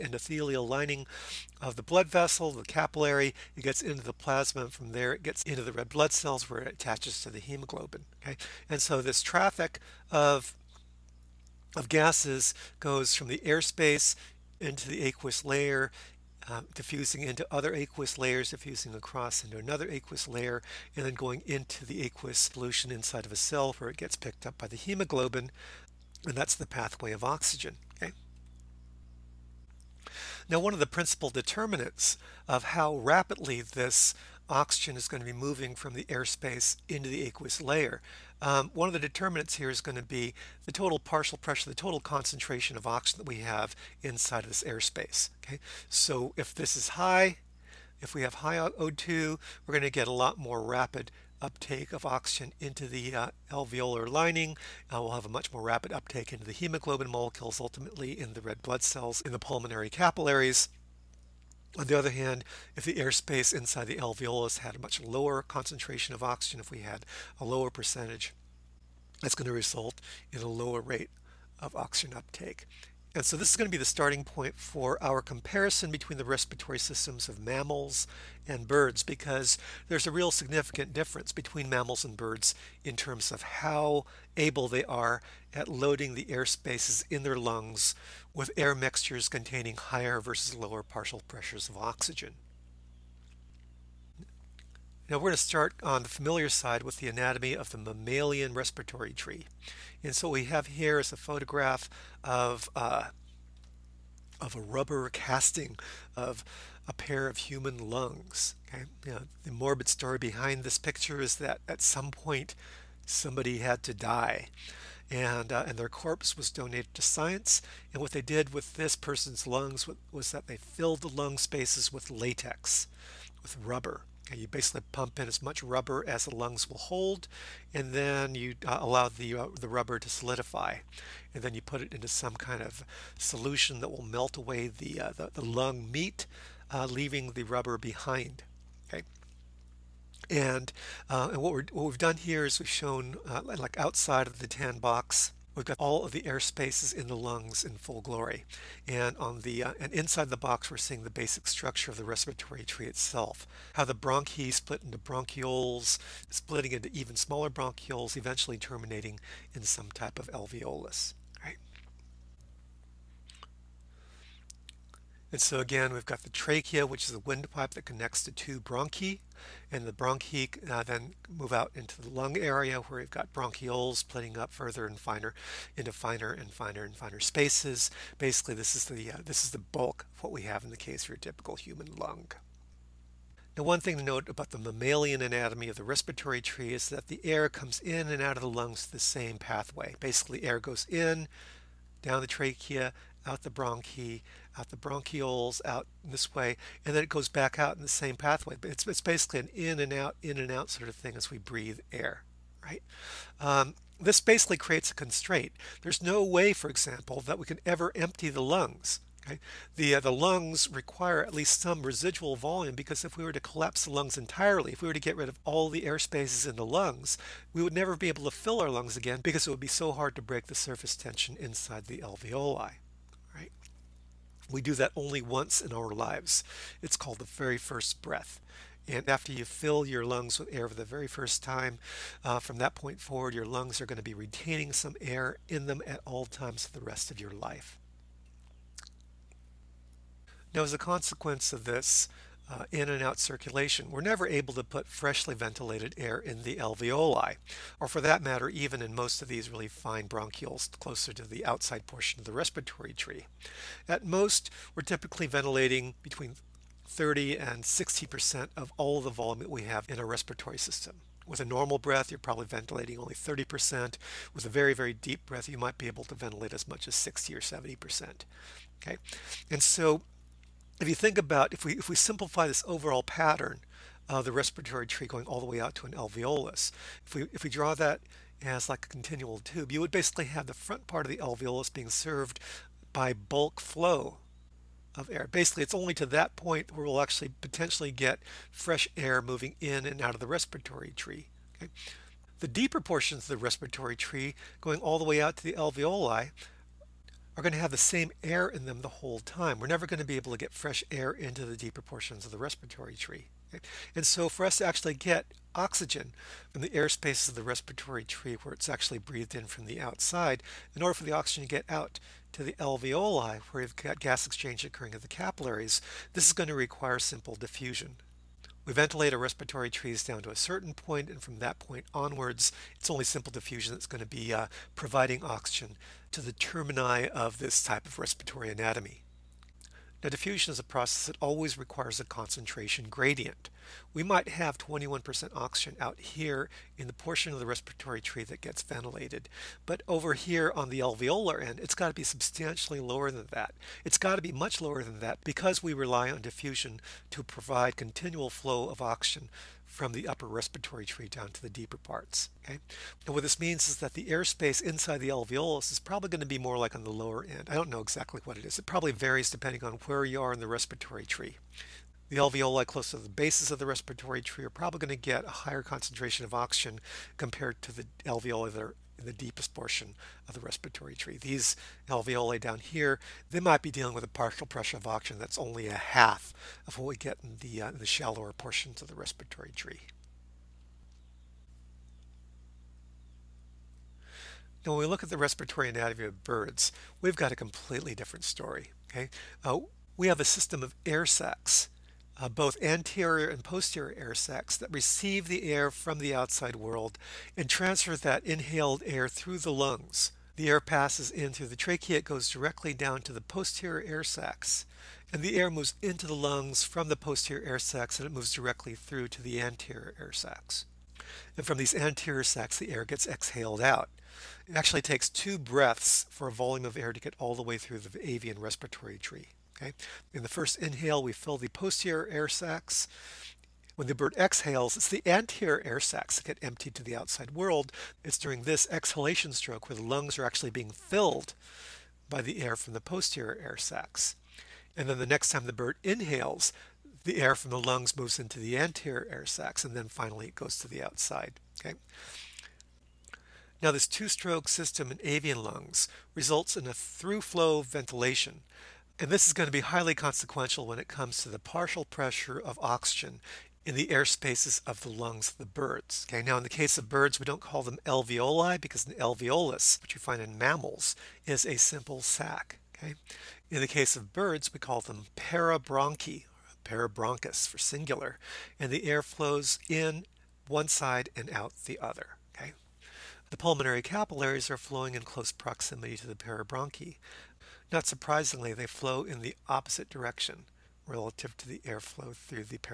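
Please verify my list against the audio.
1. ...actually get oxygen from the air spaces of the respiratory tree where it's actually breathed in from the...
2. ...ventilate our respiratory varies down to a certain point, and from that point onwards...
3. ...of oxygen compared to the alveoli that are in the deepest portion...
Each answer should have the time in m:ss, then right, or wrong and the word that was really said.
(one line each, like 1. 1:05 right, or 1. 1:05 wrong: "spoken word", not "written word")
1. 5:04 right
2. 5:18 wrong: "trees", not "varies"
3. 6:06 right.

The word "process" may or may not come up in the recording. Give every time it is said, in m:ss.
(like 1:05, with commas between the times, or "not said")
5:30.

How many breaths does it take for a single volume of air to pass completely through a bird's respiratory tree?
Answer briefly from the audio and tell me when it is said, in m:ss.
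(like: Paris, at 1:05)
2, at 6:55.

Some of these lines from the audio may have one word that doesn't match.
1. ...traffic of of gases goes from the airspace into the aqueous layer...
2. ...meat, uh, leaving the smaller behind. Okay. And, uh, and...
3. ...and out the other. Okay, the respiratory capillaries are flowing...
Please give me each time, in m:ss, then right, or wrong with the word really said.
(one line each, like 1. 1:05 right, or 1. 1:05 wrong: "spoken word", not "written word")
1. 0:09 right
2. 2:15 wrong: "rubber", not "smaller"
3. 7:51 wrong: "pulmonary", not "respiratory".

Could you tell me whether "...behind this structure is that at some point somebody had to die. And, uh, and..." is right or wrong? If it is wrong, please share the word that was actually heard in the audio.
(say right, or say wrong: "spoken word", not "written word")
wrong: "picture", not "structure".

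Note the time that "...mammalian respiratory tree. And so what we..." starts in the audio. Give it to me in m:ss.
1:37.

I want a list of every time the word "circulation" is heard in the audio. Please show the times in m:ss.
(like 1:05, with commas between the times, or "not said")
4:03.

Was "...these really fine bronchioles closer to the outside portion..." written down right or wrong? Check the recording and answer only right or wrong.
right.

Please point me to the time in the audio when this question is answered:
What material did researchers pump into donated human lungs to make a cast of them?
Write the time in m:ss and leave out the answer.
2:02.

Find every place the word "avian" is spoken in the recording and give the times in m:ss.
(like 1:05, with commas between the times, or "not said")
6:58, 7:25.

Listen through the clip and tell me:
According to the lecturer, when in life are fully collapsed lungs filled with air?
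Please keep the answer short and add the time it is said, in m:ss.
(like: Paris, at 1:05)
The very first breath, at 3:47.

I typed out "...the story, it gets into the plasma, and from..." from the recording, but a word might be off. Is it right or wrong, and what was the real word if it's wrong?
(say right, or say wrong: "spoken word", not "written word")
wrong: "capillary", not "story".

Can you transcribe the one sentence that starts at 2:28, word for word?
And on the uh, and inside the box, we're seeing the basic structure of the respiratory tree itself.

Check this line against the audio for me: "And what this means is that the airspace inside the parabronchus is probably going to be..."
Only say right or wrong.
wrong.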